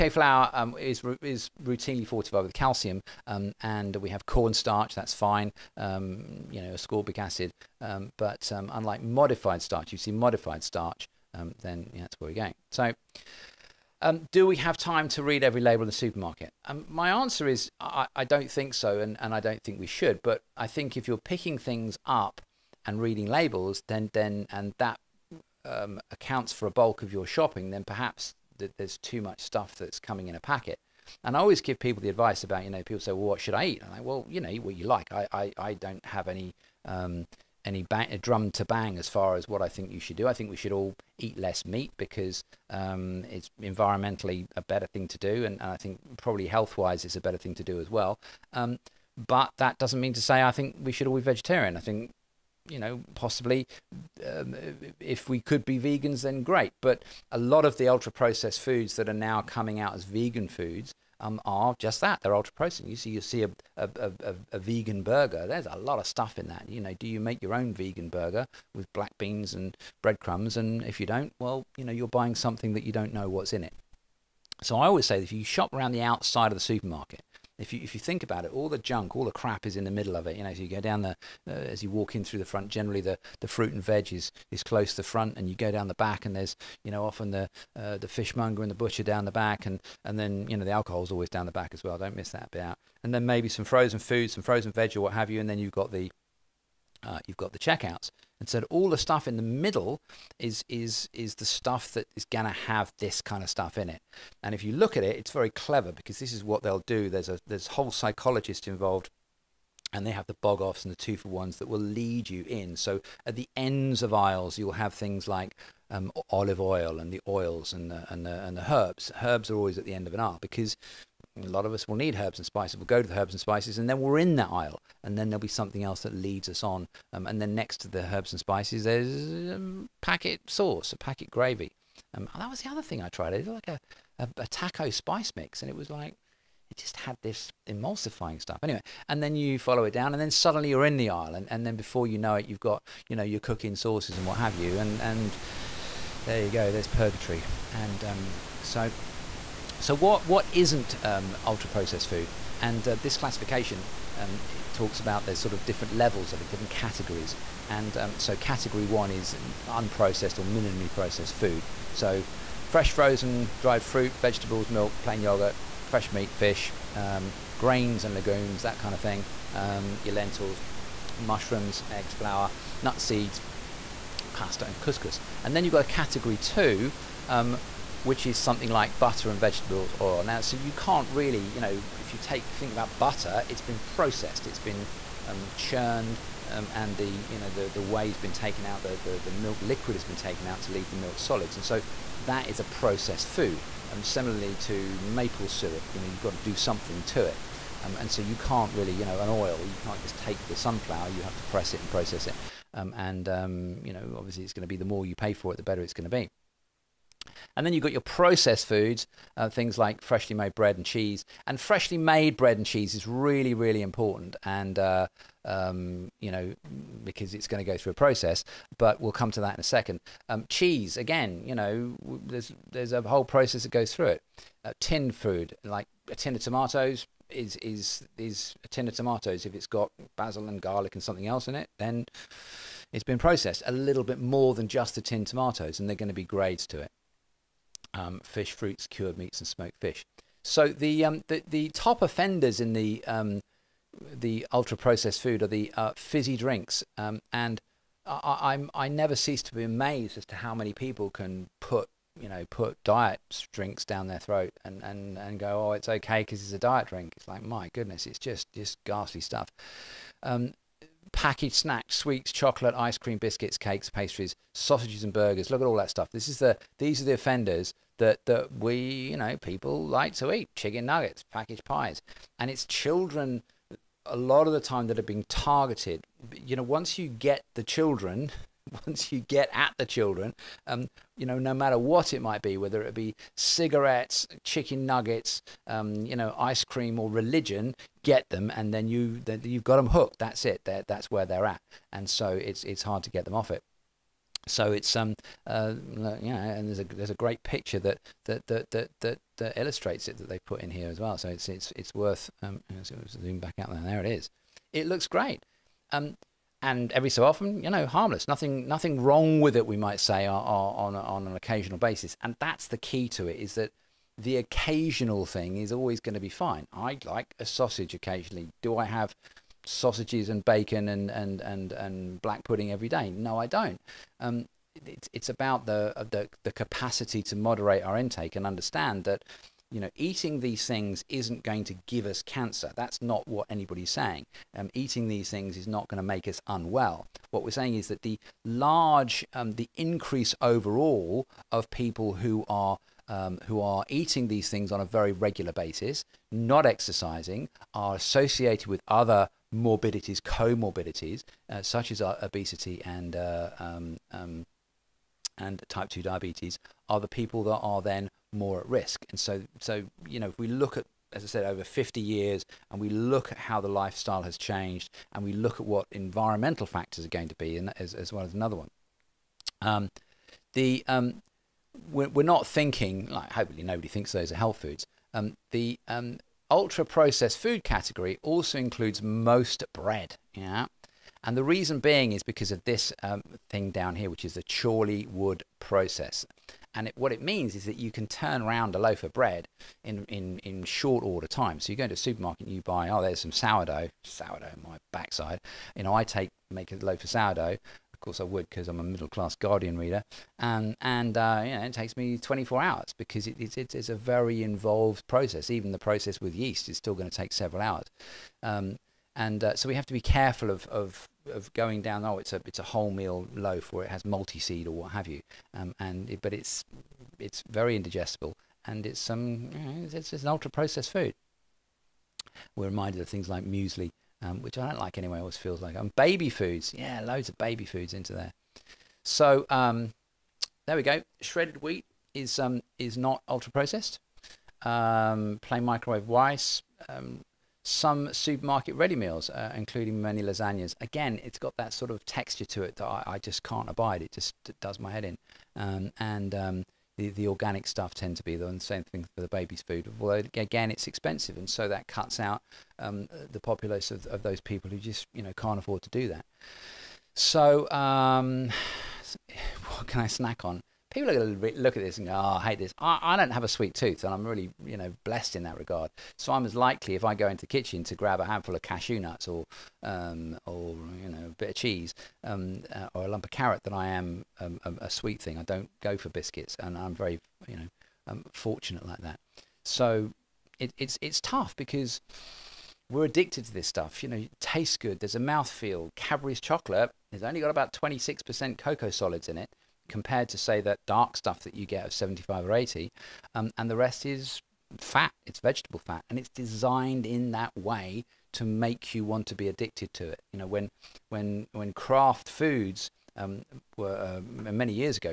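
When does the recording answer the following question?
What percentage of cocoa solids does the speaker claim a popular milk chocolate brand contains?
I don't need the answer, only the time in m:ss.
8:07.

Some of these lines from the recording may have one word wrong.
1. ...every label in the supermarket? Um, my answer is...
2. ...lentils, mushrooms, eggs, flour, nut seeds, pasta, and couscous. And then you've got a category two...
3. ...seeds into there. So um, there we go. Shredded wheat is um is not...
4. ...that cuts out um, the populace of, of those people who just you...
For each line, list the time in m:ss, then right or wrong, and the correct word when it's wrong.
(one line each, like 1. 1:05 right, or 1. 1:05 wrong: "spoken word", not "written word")
1. 0:15 right
2. 2:50 right
3. 7:07 wrong: "foods", not "seeds"
4. 7:31 right.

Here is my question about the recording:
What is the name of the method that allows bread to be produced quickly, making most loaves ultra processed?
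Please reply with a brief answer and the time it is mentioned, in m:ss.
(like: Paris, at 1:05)
Chorleywood process, at 6:24.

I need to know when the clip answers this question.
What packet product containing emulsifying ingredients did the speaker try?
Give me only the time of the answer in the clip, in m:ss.
2:14.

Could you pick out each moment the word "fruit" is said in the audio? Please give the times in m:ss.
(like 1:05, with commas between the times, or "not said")
1:23, 2:43, 3:58.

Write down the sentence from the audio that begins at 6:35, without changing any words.
You know, I take, make a loaf of sourdough.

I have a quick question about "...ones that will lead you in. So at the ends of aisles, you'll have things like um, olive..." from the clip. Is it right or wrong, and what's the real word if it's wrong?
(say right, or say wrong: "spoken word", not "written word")
right.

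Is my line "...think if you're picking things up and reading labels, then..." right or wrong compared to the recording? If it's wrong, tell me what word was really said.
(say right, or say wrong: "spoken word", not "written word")
right.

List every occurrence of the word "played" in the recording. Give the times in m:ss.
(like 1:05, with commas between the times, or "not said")
not said.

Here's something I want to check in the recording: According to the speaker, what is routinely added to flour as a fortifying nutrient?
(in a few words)
Calcium.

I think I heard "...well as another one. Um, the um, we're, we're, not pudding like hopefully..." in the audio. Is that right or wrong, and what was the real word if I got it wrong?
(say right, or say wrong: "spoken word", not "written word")
wrong: "thinking", not "pudding".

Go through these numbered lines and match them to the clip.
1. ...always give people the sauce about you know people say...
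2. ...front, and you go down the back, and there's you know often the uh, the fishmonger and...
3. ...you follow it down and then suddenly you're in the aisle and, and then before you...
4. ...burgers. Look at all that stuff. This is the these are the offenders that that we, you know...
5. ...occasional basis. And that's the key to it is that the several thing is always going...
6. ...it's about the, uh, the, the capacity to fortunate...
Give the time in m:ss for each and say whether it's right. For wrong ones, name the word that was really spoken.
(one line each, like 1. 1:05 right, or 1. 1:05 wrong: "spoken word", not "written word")
1. 0:31 wrong: "advice", not "sauce"
2. 1:25 right
3. 2:19 right
4. 4:25 right
5. 5:11 wrong: "occasional", not "several"
6. 5:25 wrong: "moderate", not "fortunate".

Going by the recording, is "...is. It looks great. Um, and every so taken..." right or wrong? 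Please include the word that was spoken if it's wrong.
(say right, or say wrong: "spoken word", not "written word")
wrong: "often", not "taken".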